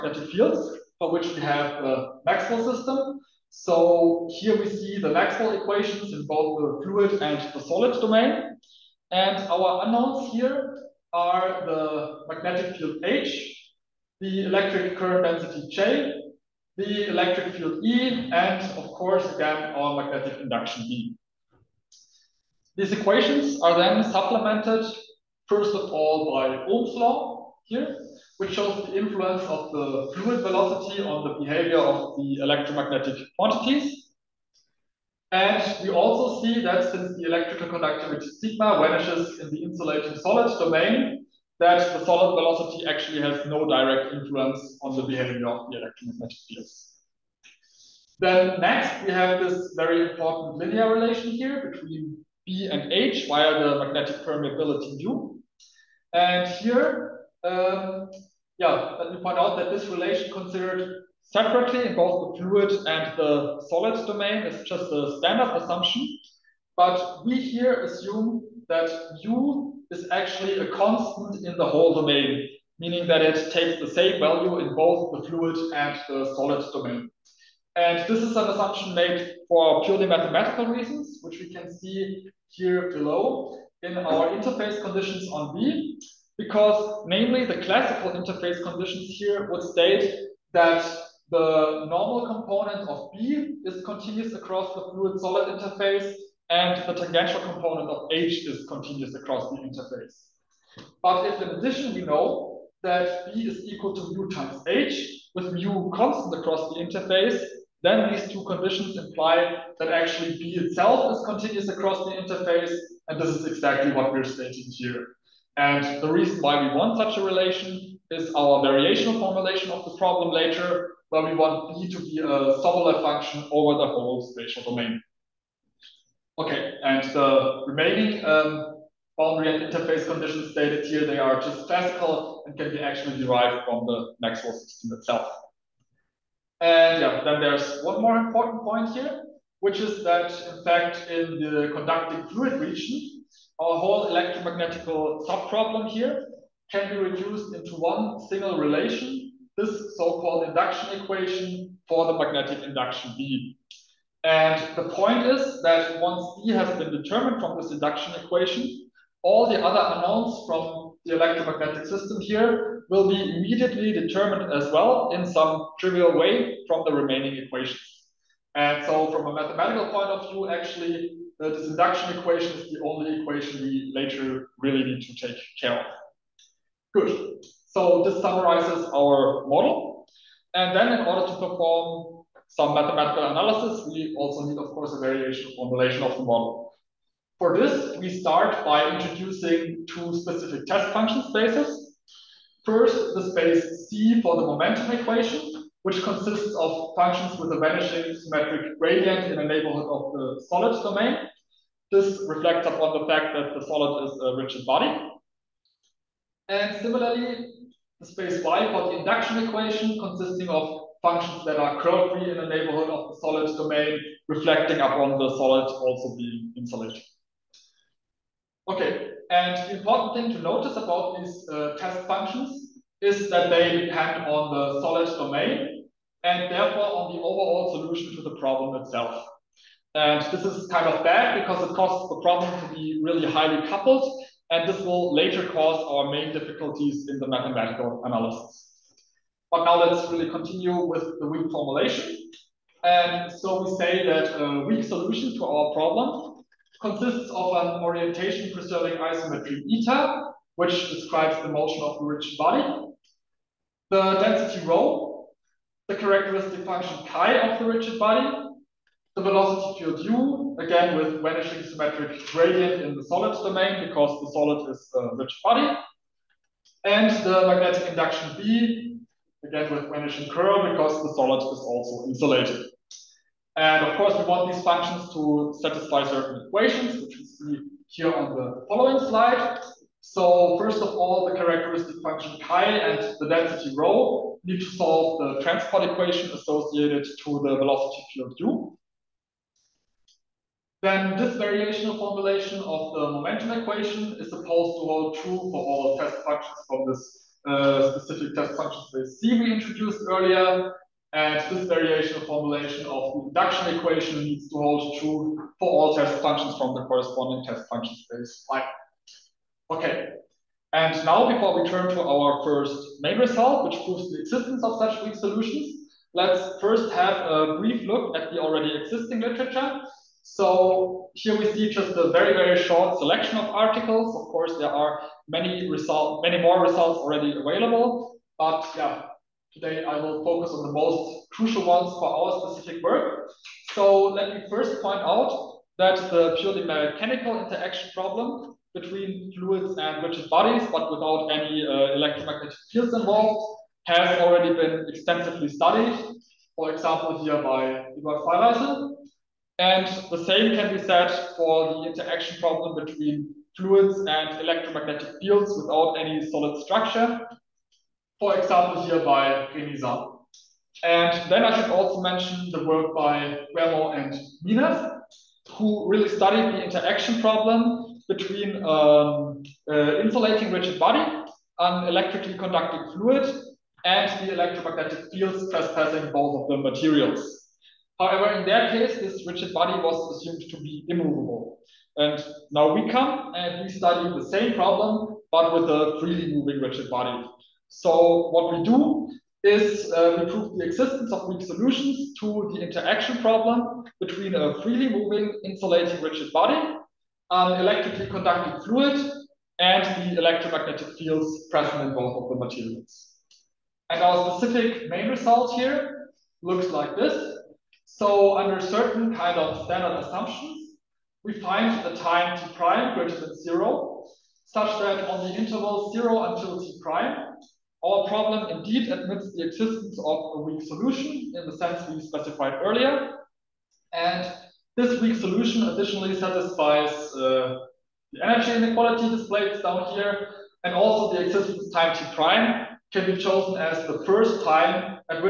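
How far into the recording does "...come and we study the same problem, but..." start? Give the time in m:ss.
6:22.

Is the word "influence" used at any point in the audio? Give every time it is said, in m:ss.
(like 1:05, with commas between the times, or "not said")
0:28, 0:44.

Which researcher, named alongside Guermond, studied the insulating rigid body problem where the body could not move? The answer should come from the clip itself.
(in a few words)
Minev.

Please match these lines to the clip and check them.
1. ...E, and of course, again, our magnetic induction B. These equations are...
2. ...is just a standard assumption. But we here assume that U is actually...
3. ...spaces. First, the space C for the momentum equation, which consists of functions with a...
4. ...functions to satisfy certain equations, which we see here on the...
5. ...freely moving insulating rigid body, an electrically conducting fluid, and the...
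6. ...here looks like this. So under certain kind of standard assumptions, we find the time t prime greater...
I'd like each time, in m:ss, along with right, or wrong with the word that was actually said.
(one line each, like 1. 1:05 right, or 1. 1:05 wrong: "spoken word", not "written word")
1. 0:17 right
2. 1:04 right
3. 3:11 right
4. 4:34 right
5. 6:34 right
6. 6:45 right.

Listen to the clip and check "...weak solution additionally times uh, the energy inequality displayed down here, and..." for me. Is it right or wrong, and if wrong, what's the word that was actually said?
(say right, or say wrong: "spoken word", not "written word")
wrong: "satisfies", not "times".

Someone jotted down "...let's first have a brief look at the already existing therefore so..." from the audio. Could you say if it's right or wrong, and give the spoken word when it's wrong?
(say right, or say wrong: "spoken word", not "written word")
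wrong: "literature", not "therefore".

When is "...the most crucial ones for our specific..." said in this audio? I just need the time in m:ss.
5:30.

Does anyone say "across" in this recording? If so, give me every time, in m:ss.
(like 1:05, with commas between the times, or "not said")
1:34, 1:39, 1:46, 1:51.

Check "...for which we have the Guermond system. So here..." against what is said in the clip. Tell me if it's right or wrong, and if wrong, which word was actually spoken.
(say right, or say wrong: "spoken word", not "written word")
wrong: "Maxwell", not "Guermond".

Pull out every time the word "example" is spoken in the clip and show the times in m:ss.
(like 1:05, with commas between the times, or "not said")
5:46, 5:58.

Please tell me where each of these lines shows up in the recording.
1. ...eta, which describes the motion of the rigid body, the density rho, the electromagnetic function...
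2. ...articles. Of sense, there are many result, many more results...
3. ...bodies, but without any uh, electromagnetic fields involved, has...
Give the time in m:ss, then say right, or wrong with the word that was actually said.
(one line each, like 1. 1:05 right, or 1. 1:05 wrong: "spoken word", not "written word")
1. 4:09 wrong: "characteristic", not "electromagnetic"
2. 5:23 wrong: "course", not "sense"
3. 5:40 right.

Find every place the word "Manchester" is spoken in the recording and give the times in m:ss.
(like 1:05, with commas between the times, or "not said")
not said.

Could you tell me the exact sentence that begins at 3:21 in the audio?
This reflects upon the fact that the solid is a rigid body.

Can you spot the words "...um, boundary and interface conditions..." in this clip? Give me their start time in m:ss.
2:08.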